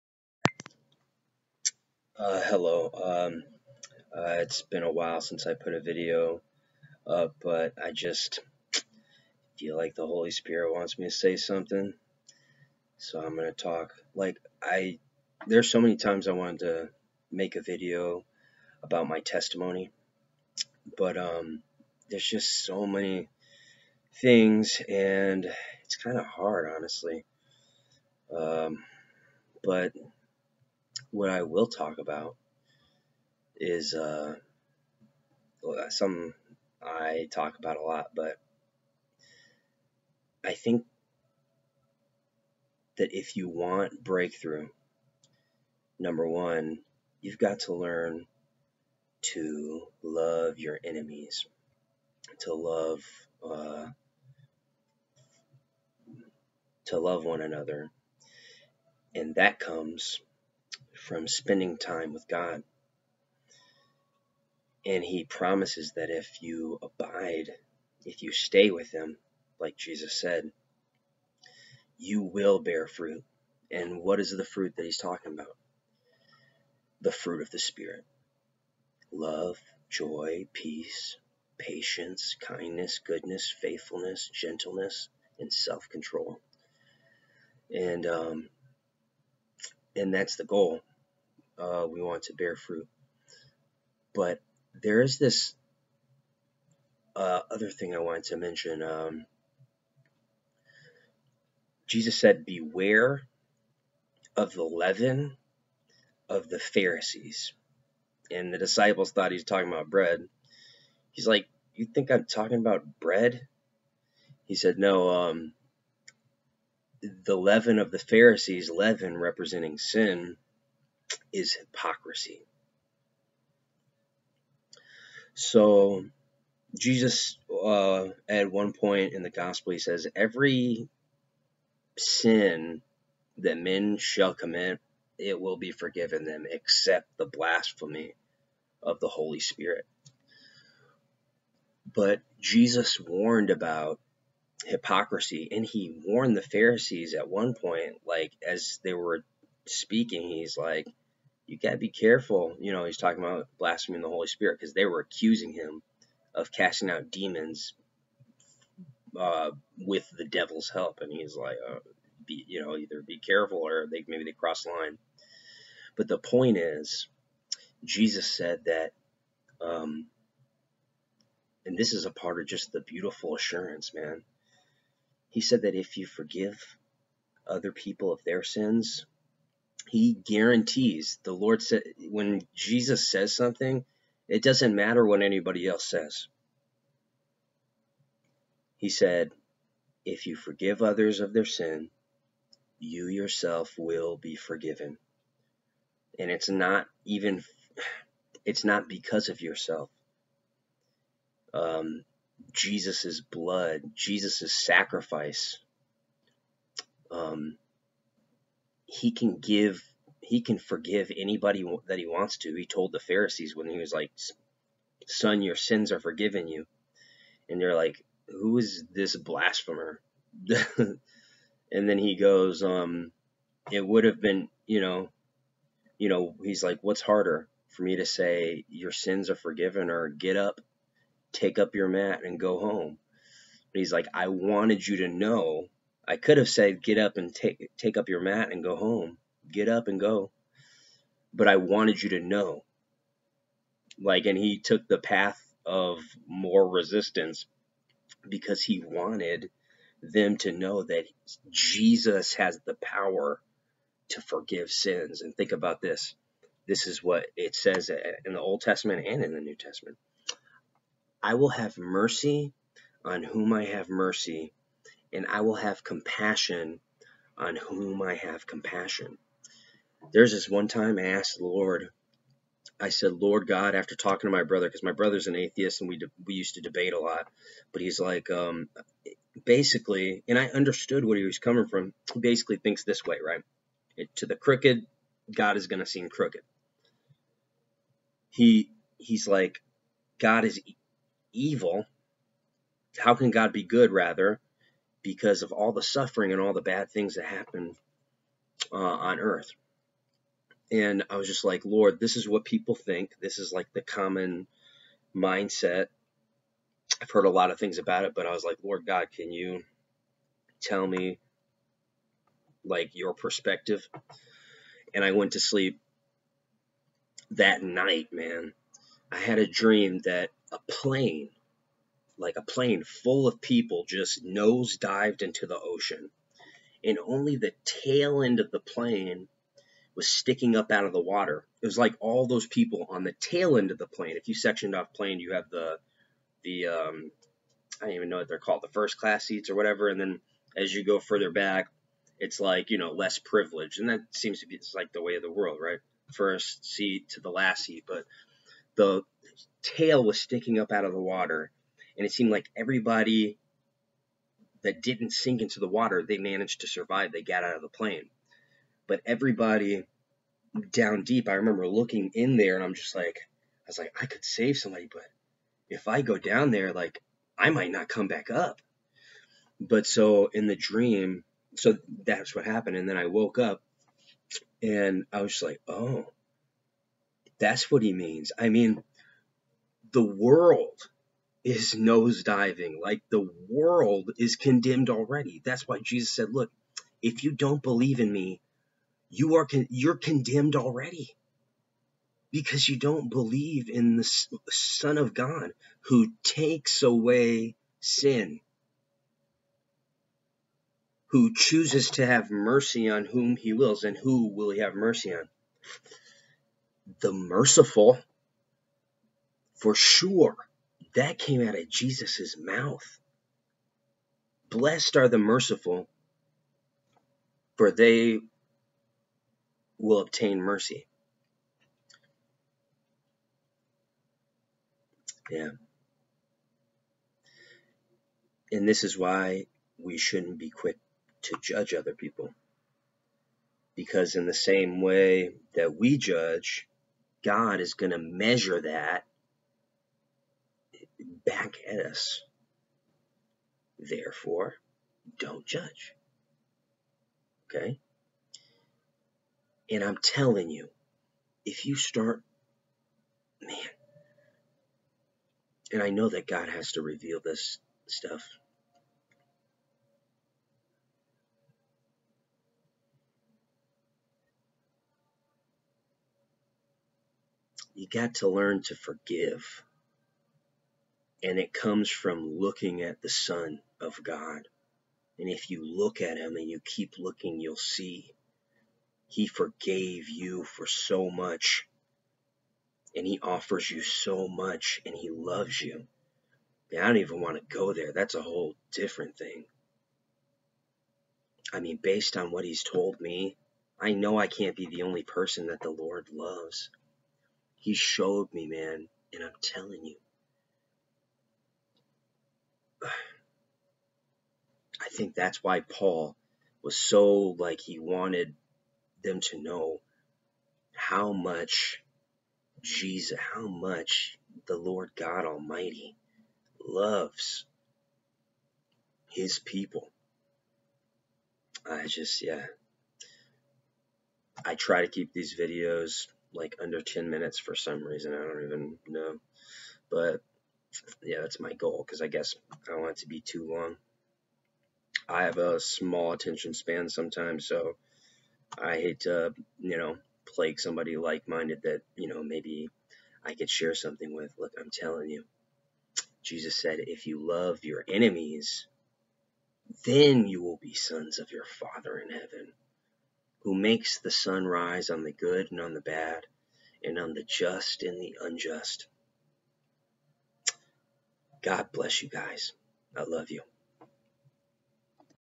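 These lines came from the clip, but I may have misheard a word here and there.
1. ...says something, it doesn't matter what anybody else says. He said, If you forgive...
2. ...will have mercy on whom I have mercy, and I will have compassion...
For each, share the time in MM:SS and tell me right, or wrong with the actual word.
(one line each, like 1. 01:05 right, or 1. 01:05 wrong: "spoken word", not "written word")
1. 03:03 right
2. 04:21 right.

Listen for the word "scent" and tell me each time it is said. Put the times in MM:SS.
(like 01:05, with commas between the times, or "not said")
not said.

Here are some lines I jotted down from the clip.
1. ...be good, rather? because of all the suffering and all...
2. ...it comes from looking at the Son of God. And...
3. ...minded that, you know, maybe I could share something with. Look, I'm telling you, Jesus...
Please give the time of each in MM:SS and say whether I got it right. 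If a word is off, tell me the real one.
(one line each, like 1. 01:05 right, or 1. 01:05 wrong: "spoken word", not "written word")
1. 04:53 right
2. 07:51 right
3. 09:01 right.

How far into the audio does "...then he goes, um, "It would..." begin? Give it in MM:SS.
03:41.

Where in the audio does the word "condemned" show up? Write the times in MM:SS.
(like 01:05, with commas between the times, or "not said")
06:24, 06:29.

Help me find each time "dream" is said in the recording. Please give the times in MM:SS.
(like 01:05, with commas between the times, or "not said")
05:19, 06:10.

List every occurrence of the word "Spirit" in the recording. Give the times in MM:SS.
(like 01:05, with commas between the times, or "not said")
00:10, 01:17, 02:19, 02:34.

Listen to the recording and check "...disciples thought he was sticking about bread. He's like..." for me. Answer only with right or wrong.
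wrong.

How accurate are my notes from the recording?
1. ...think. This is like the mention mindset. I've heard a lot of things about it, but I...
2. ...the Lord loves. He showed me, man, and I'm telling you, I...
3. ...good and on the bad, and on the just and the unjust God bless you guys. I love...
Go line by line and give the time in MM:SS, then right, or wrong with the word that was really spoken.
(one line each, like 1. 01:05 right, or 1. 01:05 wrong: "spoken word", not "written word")
1. 05:02 wrong: "common", not "mention"
2. 08:15 right
3. 09:15 right.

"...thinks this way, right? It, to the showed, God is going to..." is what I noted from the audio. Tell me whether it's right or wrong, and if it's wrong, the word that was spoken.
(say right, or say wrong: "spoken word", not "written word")
wrong: "crooked", not "showed".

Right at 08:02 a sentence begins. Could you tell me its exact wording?
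And he offers you so much and he loves you.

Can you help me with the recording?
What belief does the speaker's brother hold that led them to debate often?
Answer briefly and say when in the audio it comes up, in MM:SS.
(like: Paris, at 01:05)
Atheist, at 04:35.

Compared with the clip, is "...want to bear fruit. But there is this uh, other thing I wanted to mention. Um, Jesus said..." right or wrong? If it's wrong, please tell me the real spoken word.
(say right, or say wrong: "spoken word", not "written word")
right.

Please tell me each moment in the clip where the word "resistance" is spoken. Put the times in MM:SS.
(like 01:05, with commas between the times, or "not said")
04:06.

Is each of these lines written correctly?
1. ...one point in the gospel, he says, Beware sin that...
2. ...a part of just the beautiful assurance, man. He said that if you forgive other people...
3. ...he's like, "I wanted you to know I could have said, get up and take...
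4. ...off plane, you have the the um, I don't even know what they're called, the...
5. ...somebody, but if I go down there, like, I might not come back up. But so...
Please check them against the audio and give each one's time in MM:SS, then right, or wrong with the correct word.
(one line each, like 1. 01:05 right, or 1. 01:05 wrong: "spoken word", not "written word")
1. 02:08 wrong: "Every", not "Beware"
2. 02:52 right
3. 03:53 right
4. 05:34 right
5. 06:04 right.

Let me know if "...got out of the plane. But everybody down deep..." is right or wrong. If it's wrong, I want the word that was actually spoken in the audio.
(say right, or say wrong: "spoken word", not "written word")
right.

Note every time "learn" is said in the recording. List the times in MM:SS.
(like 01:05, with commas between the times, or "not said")
00:47, 07:48.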